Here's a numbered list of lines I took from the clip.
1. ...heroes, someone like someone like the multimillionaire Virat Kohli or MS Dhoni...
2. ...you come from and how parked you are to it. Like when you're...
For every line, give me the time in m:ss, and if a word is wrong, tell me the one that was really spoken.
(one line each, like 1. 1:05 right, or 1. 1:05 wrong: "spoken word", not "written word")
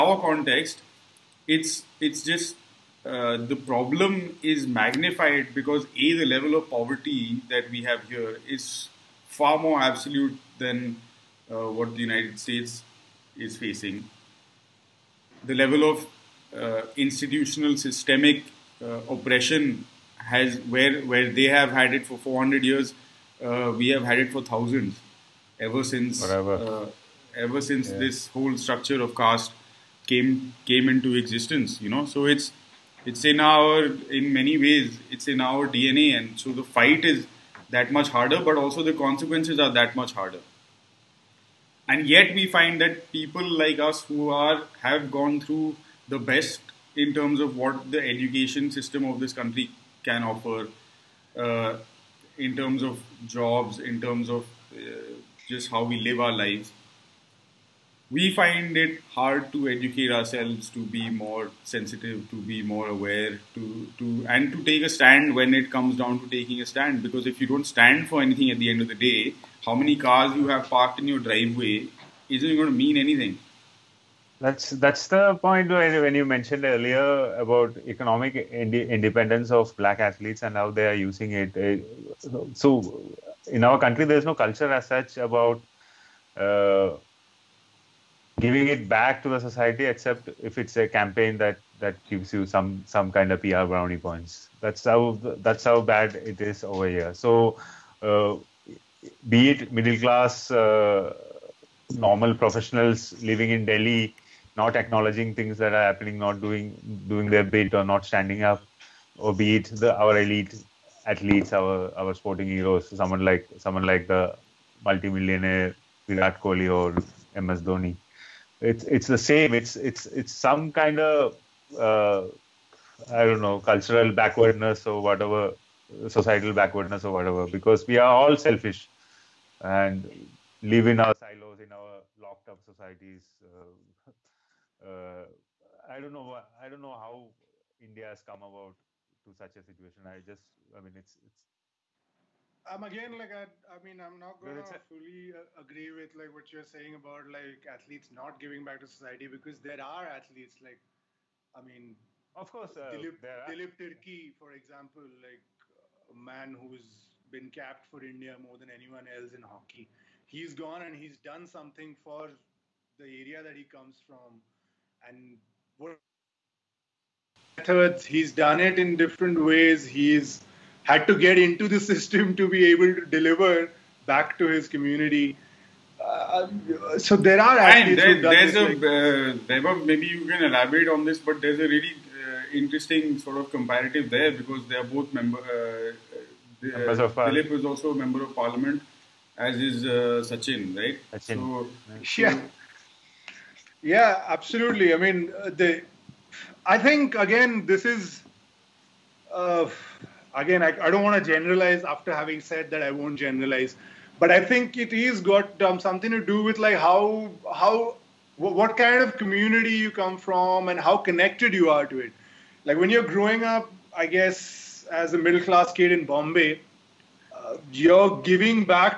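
1. 1:52 right
2. 3:29 wrong: "connected", not "parked".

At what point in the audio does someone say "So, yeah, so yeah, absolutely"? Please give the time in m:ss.
3:11.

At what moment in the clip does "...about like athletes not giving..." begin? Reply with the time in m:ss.
2:26.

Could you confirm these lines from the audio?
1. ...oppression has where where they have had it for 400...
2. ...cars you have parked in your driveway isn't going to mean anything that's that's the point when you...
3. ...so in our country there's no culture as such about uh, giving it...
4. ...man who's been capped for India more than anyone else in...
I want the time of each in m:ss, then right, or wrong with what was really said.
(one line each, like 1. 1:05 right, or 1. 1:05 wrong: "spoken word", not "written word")
1. 0:19 right
2. 1:09 right
3. 1:22 right
4. 2:36 right.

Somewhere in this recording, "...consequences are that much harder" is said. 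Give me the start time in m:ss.
0:38.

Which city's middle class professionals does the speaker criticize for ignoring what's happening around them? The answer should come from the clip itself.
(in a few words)
Delhi.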